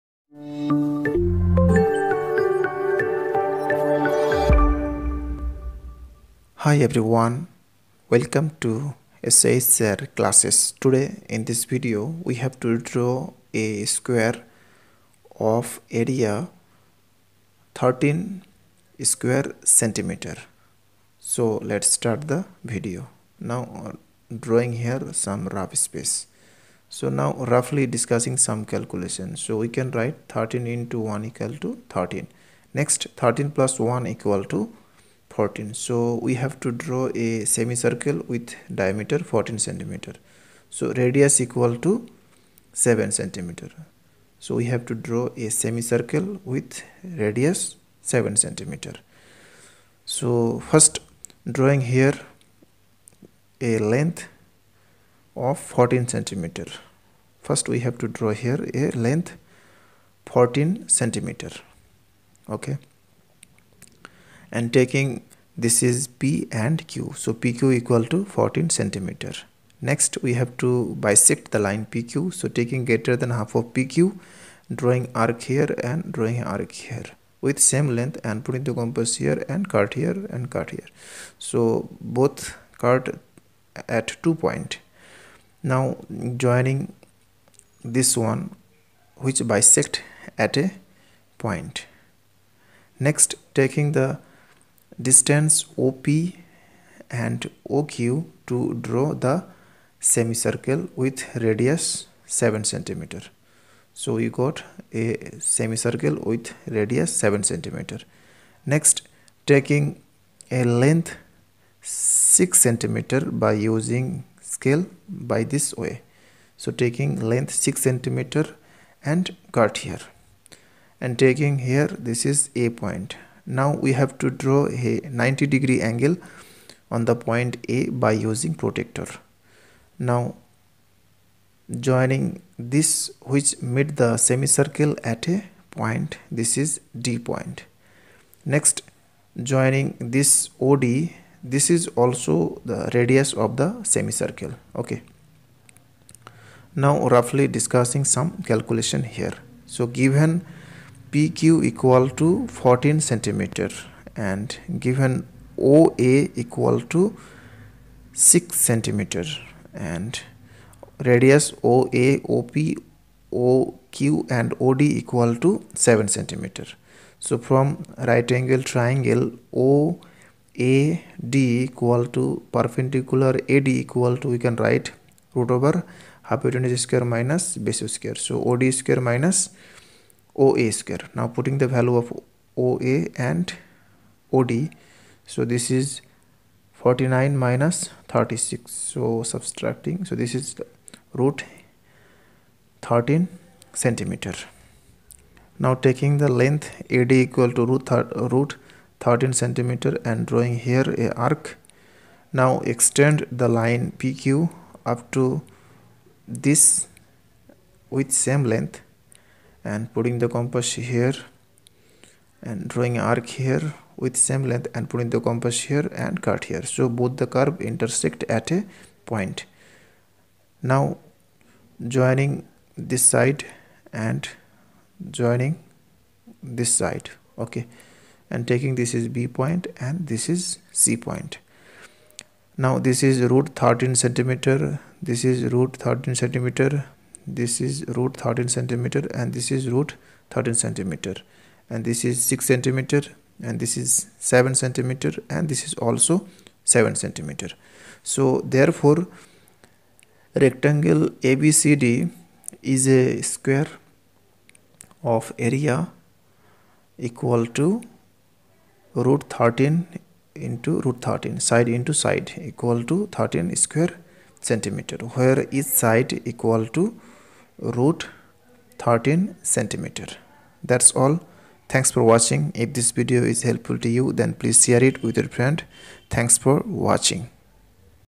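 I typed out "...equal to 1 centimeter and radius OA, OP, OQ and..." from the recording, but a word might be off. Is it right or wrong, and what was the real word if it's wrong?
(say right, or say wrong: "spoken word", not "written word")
wrong: "6", not "1".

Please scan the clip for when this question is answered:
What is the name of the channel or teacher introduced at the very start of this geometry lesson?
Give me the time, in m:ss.
0:09.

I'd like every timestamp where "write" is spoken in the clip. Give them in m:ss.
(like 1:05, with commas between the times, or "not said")
0:29, 2:54.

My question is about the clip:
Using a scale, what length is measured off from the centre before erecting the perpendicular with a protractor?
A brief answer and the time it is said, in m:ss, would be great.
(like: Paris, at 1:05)
6 centimeter, at 1:56.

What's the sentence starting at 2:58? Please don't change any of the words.
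So OD square minus minus OA square.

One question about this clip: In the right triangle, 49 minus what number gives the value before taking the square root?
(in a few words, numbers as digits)
36.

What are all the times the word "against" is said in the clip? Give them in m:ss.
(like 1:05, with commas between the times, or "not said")
not said.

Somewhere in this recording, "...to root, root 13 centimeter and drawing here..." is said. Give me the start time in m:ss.
3:17.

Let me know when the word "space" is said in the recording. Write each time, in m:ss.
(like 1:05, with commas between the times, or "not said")
0:25.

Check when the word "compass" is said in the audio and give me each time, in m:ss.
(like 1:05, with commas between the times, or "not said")
1:18, 3:30, 3:35.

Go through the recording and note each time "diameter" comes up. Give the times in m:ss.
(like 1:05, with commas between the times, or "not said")
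0:38.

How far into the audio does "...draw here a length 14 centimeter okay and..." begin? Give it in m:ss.
0:58.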